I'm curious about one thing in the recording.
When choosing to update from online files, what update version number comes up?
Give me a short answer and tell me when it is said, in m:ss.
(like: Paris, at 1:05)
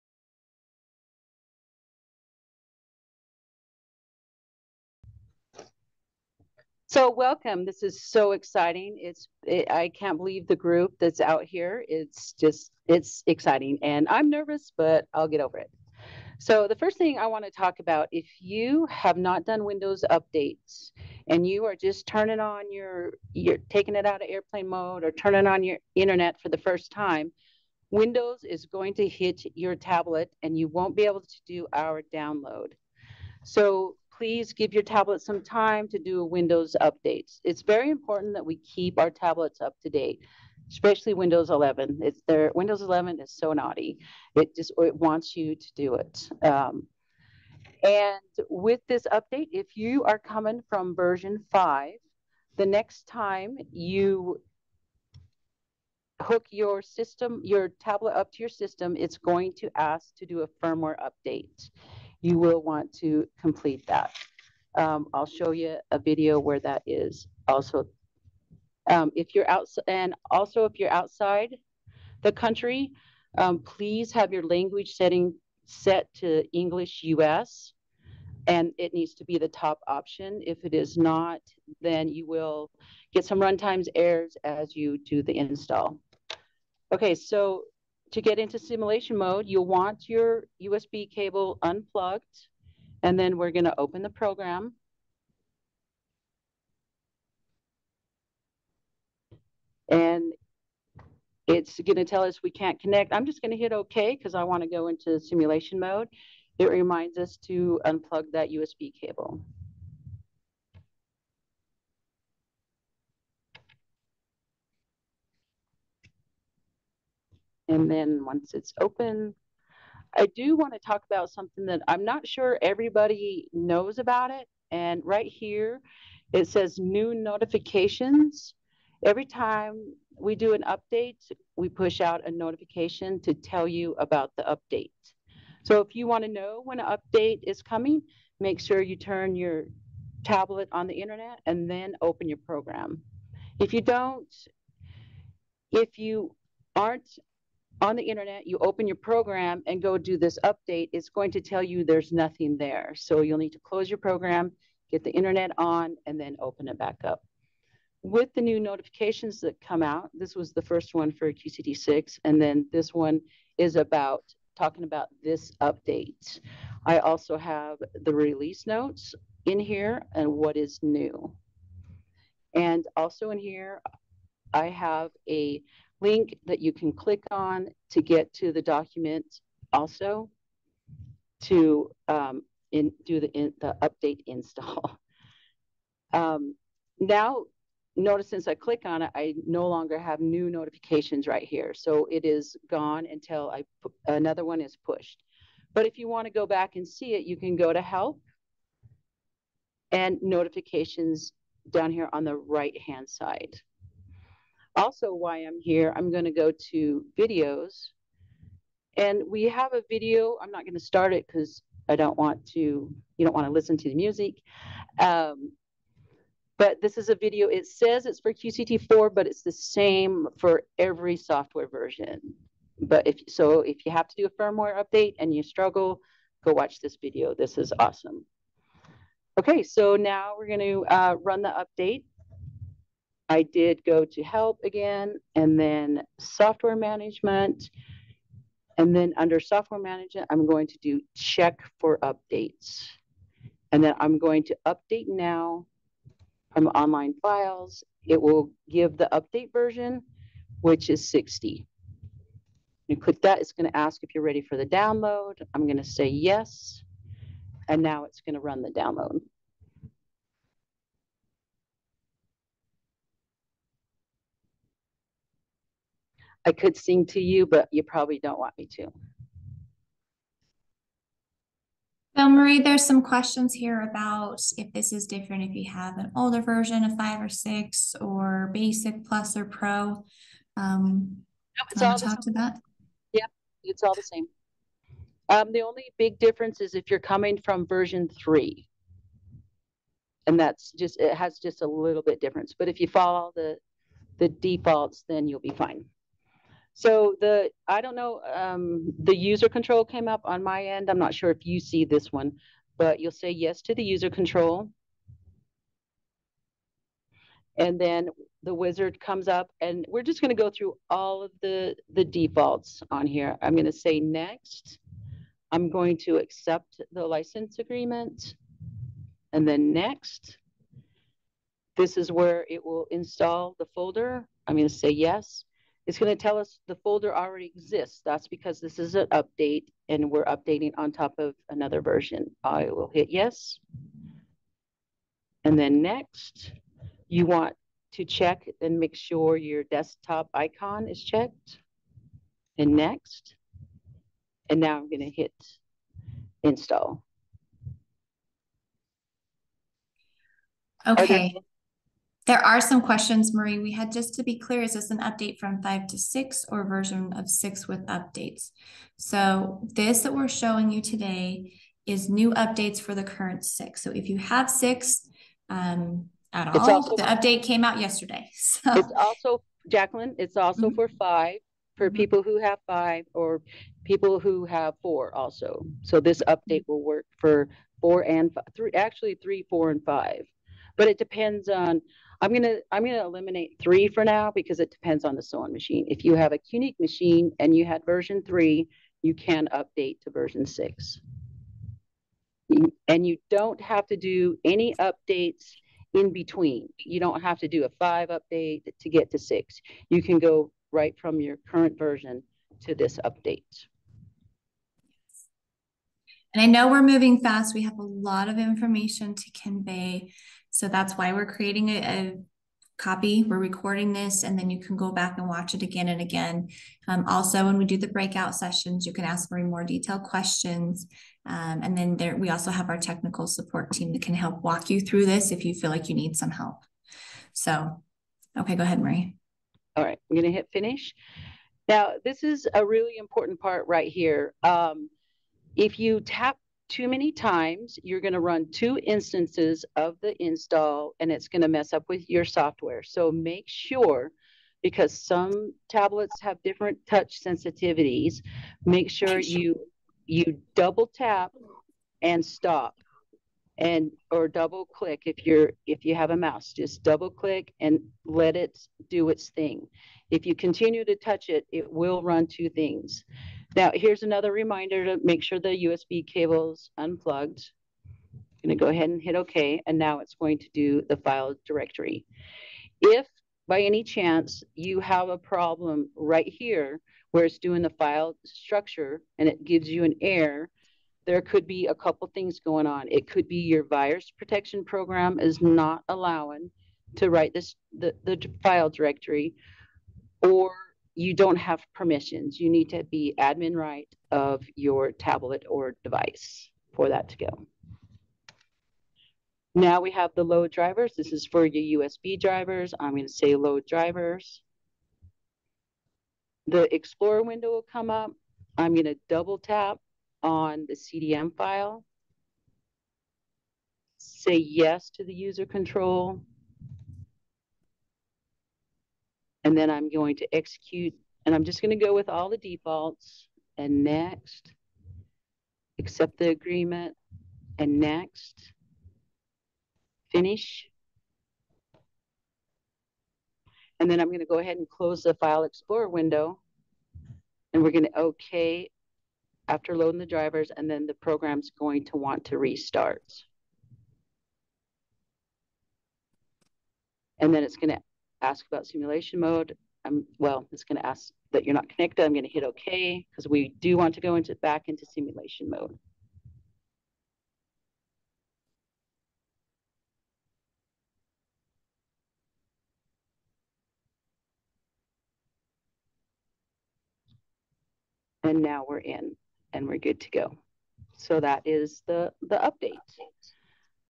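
60, at 4:11.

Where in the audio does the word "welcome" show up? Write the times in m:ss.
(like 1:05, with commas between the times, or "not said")
0:07.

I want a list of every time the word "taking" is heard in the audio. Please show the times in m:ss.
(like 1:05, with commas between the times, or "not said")
0:23.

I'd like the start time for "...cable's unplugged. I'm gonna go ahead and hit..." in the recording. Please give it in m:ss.
7:46.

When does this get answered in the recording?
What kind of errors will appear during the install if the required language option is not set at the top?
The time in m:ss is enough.
1:23.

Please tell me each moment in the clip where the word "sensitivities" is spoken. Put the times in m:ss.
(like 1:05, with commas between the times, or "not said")
7:27.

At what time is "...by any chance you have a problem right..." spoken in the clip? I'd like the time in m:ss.
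7:53.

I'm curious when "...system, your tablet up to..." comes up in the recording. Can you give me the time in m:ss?
0:56.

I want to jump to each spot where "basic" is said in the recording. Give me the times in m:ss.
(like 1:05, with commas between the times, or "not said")
4:38.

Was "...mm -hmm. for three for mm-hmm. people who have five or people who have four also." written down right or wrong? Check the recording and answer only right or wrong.
wrong.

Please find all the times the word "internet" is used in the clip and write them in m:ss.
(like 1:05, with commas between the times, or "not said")
0:25, 2:20, 2:28, 2:35.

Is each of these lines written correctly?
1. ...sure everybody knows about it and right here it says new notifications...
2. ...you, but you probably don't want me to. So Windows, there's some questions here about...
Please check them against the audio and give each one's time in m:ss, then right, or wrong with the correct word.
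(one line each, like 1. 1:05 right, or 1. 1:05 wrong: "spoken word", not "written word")
1. 2:02 right
2. 4:27 wrong: "Marie", not "Windows".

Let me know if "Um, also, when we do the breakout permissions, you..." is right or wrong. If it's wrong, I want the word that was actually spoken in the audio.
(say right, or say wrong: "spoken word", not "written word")
wrong: "sessions", not "permissions".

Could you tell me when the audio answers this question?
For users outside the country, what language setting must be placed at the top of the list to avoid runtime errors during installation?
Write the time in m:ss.
1:16.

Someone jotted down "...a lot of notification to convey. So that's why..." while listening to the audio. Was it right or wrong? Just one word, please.
wrong.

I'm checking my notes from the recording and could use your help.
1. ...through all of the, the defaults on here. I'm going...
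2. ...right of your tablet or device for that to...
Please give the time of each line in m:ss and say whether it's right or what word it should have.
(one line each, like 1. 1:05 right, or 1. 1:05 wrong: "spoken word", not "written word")
1. 5:10 right
2. 8:13 right.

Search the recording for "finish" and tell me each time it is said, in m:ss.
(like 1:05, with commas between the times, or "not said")
7:10, 8:50.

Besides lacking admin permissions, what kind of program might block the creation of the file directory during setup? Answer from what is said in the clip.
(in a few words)
virus protection program.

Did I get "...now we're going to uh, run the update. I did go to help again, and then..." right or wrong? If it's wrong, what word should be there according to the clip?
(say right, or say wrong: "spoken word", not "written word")
right.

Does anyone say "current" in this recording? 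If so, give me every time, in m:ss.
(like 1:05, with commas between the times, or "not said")
6:03, 6:41.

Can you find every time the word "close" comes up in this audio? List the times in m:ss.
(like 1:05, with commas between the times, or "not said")
2:33, 8:54.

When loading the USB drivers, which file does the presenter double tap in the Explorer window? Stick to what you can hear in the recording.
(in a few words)
CDM file.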